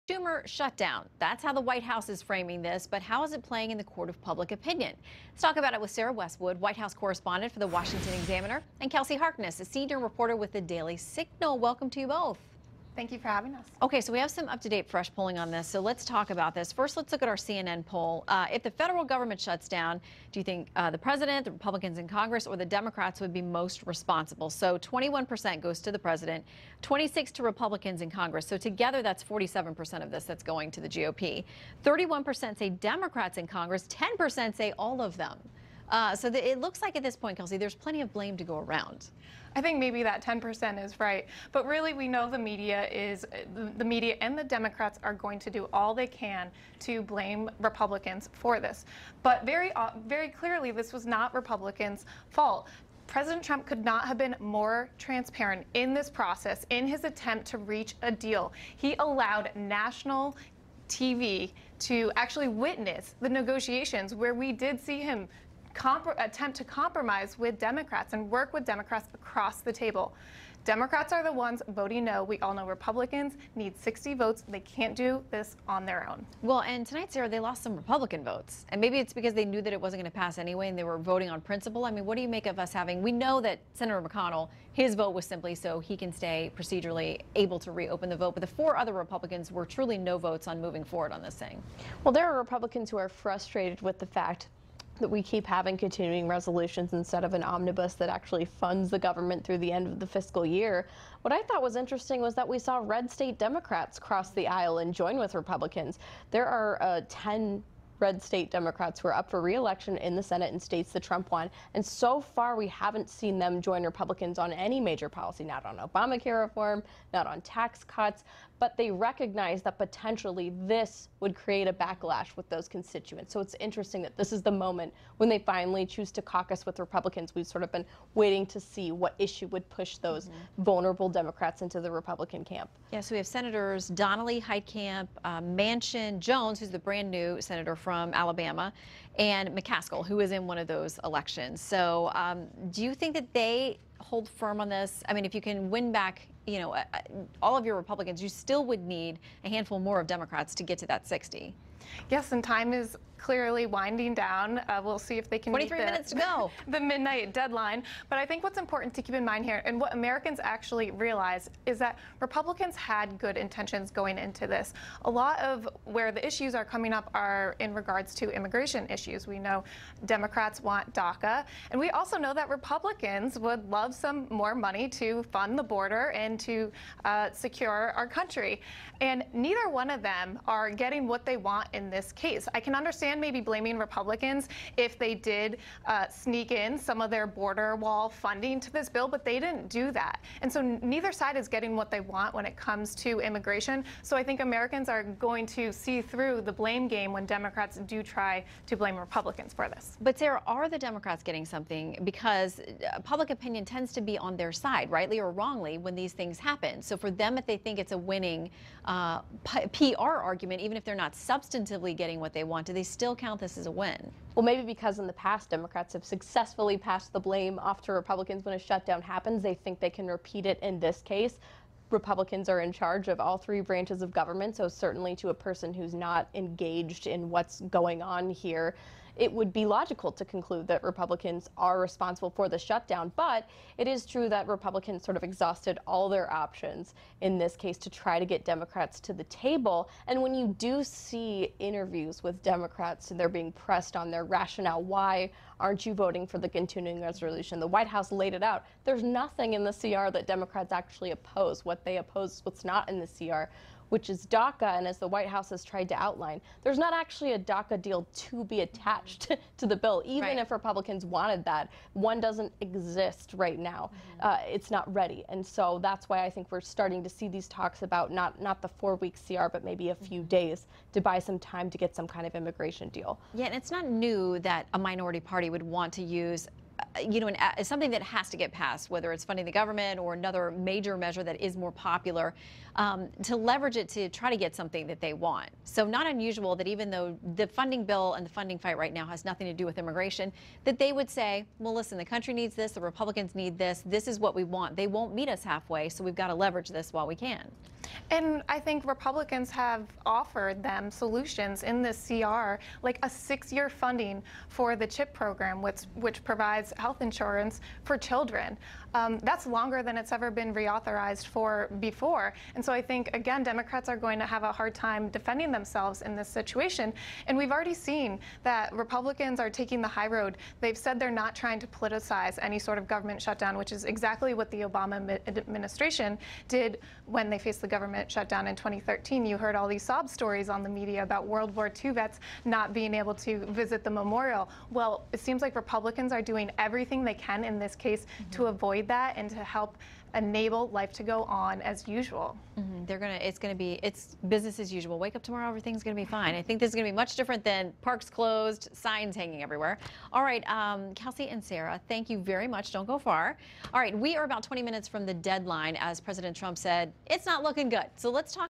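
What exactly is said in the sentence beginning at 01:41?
What I thought was interesting was that we saw red state Democrats cross the aisle and join with Republicans.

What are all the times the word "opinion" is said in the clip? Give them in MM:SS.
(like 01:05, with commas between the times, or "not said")
00:04, 03:23.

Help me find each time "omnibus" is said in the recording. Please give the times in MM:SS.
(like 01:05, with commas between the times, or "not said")
01:37.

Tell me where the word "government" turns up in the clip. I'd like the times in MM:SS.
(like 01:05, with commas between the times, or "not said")
00:19, 01:38, 03:44, 04:39, 05:22, 05:27.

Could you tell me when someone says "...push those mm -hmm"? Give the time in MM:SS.
02:09.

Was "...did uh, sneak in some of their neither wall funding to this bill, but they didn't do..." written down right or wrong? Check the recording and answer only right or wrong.
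wrong.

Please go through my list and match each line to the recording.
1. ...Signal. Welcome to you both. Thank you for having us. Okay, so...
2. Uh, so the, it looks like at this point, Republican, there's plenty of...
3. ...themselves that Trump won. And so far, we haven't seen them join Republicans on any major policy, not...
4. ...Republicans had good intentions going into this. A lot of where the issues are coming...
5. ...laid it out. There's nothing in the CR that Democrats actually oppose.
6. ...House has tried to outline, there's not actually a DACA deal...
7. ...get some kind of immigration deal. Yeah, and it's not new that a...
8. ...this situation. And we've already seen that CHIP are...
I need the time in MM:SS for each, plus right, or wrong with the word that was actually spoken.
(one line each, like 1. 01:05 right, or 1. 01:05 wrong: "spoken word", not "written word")
1. 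00:10 right
2. 00:35 wrong: "Kelsey", not "Republican"
3. 01:50 wrong: "states", not "themselves"
4. 02:42 right
5. 04:08 right
6. 04:15 right
7. 04:31 right
8. 05:16 wrong: "Republicans", not "CHIP".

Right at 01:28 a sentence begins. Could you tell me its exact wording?
But the four other Republicans were truly no votes on moving forward on this thing.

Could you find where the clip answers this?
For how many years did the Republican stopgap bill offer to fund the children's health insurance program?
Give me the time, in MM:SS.
05:03.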